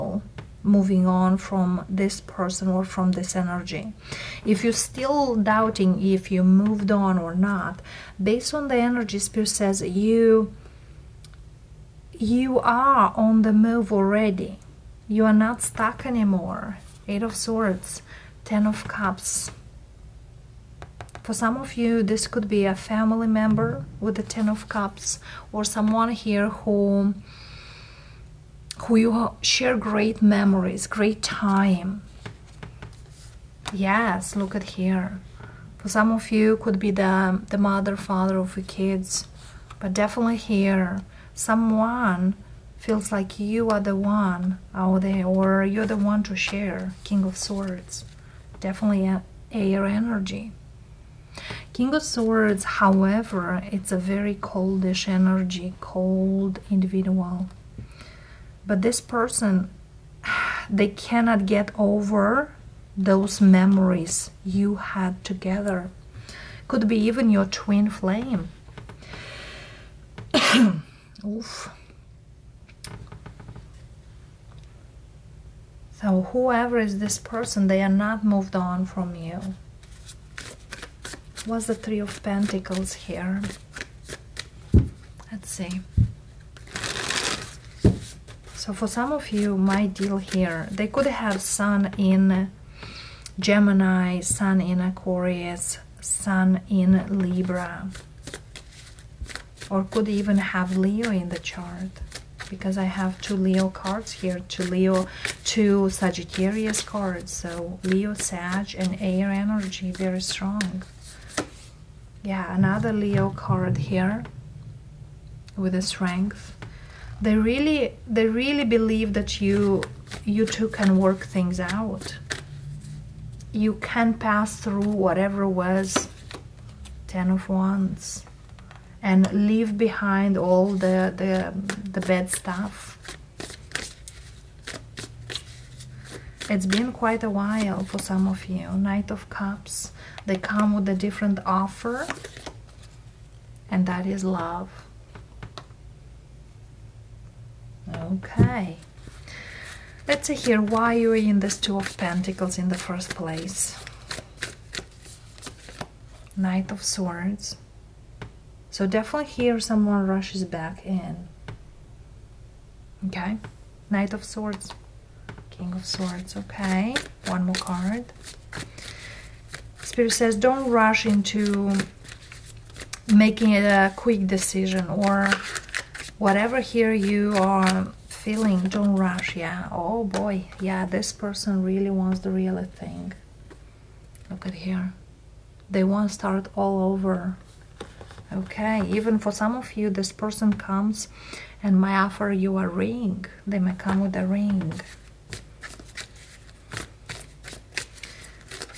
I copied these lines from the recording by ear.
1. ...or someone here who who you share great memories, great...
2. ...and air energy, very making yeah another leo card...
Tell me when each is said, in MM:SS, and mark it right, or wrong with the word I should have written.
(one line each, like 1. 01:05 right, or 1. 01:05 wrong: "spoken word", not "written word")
1. 00:25 right
2. 01:48 wrong: "strong", not "making".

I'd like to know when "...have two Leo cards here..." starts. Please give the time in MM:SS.
01:42.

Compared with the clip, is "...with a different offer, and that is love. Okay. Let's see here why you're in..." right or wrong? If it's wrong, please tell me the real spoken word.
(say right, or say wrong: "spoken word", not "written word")
right.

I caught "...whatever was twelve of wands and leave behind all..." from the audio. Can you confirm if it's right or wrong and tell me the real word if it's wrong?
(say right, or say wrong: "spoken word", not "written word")
wrong: "ten", not "twelve".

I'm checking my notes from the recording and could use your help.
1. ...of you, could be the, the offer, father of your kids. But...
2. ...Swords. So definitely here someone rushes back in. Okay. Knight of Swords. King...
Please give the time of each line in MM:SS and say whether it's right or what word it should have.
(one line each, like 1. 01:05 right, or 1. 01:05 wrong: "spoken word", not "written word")
1. 00:36 wrong: "mother", not "offer"
2. 02:36 right.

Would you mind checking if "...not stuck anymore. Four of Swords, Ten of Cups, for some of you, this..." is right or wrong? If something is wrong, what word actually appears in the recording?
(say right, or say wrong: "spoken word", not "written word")
wrong: "Eight", not "Four".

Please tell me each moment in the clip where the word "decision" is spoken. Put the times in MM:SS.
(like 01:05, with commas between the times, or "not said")
02:54.